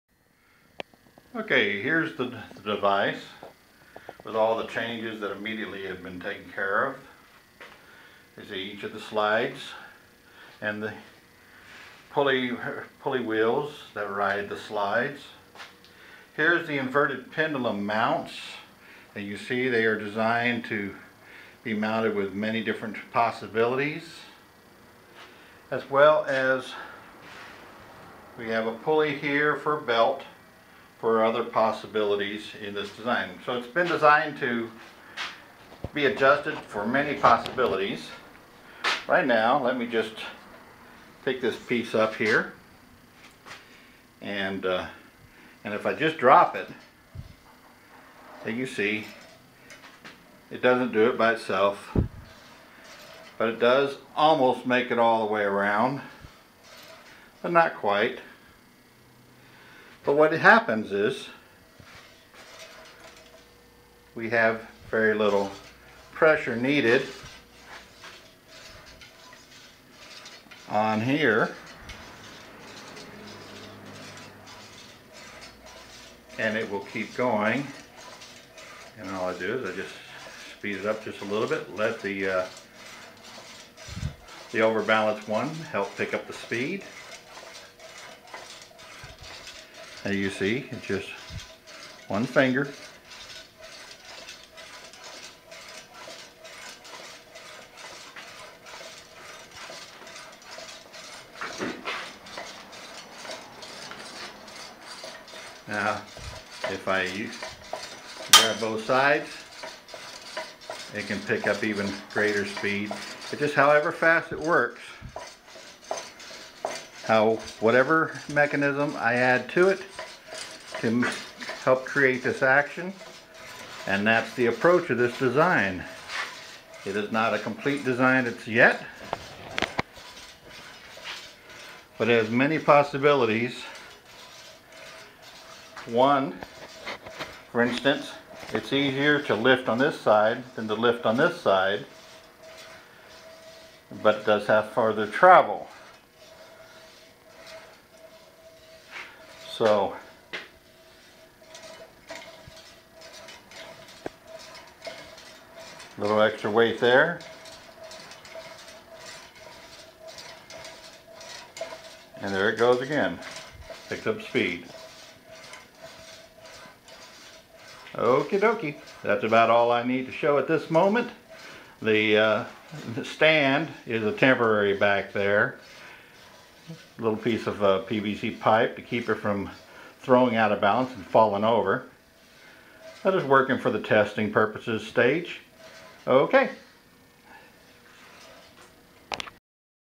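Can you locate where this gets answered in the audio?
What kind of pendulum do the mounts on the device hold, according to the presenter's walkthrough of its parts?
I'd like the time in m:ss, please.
0:16.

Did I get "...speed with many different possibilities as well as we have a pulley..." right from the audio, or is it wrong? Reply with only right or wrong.
wrong.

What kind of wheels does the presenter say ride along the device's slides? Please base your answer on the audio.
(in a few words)
pulley wheels.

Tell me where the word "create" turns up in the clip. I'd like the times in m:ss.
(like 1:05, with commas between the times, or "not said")
2:01.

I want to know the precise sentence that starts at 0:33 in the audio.
So it's been designed to be adjusted for many possibilities.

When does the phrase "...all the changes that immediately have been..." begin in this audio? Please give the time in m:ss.
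0:04.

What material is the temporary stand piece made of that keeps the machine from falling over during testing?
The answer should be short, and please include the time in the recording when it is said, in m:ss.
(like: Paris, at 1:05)
PVC pipe, at 2:57.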